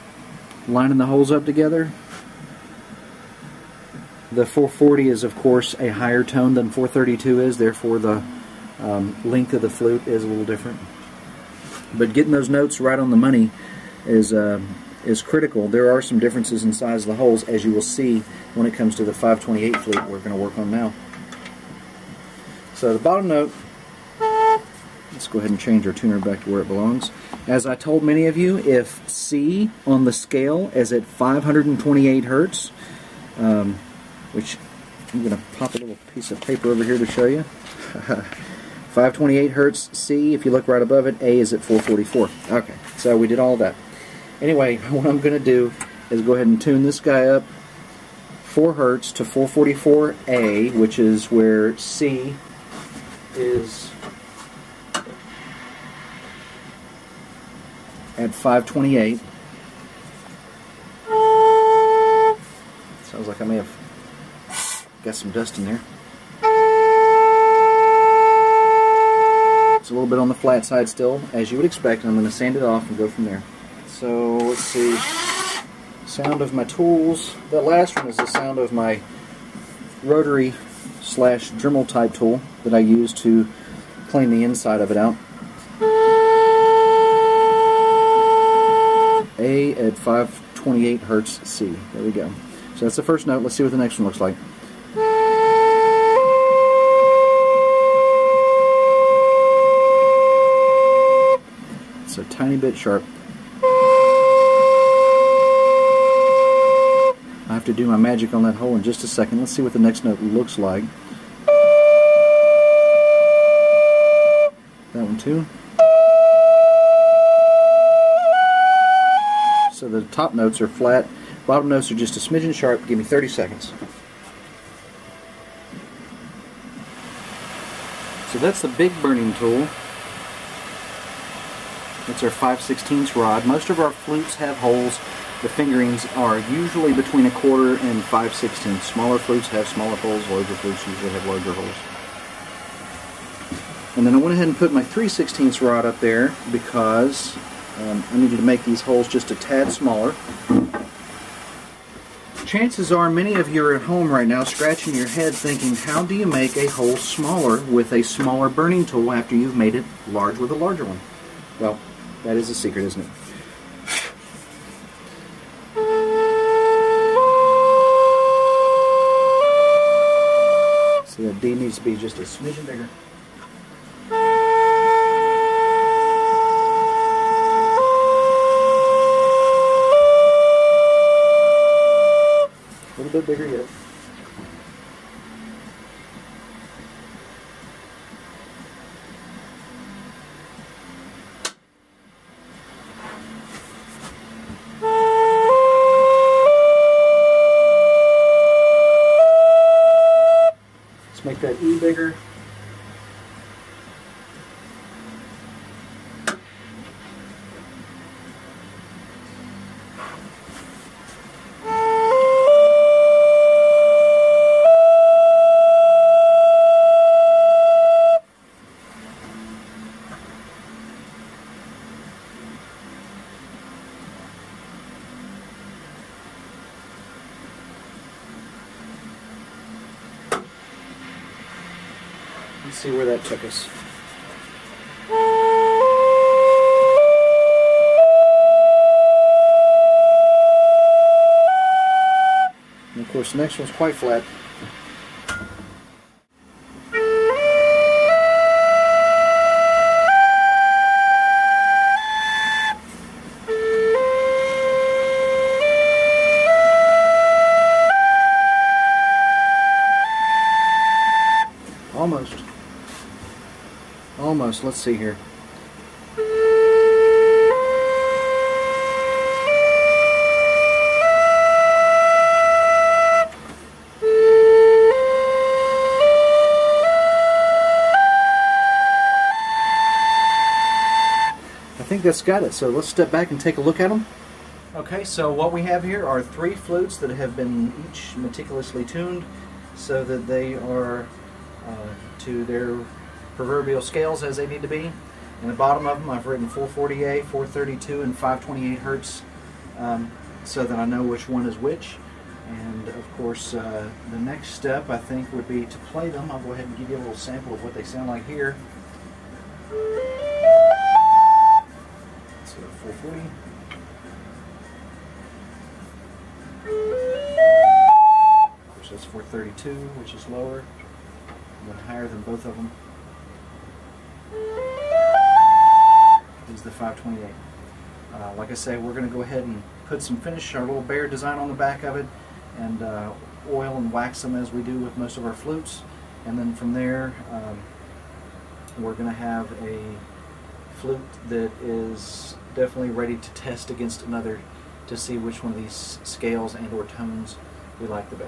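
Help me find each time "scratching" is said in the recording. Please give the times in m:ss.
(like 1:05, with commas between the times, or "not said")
2:34.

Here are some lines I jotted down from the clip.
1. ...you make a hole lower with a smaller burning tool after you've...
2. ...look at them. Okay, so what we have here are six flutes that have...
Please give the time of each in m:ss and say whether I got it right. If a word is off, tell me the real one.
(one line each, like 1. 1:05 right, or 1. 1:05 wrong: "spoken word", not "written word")
1. 2:36 wrong: "smaller", not "lower"
2. 4:43 wrong: "three", not "six".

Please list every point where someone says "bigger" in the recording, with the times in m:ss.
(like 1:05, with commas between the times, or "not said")
2:52, 3:03.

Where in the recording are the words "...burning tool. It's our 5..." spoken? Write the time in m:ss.
2:09.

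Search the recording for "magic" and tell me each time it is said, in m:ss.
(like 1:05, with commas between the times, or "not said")
1:47.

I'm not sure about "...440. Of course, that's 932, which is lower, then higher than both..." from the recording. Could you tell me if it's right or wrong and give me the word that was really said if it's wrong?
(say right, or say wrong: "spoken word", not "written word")
wrong: "432", not "932".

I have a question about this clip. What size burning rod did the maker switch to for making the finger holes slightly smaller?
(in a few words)
3/16.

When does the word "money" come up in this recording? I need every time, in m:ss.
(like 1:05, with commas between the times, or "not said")
0:13.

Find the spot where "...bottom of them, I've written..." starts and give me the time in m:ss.
4:55.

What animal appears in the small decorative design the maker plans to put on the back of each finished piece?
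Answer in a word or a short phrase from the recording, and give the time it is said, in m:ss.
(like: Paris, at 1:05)
bear, at 5:30.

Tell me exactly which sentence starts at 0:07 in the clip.
Therefore, the um, length of the flute is a little different.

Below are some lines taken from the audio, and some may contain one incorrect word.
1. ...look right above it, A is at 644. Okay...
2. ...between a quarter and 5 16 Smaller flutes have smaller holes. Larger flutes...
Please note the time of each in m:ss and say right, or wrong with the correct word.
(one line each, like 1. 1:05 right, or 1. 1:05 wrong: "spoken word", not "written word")
1. 0:40 wrong: "444", not "644"
2. 2:16 right.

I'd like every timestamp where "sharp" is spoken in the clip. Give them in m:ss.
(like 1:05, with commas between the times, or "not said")
1:42, 2:02.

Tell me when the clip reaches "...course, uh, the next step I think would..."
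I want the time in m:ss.
5:03.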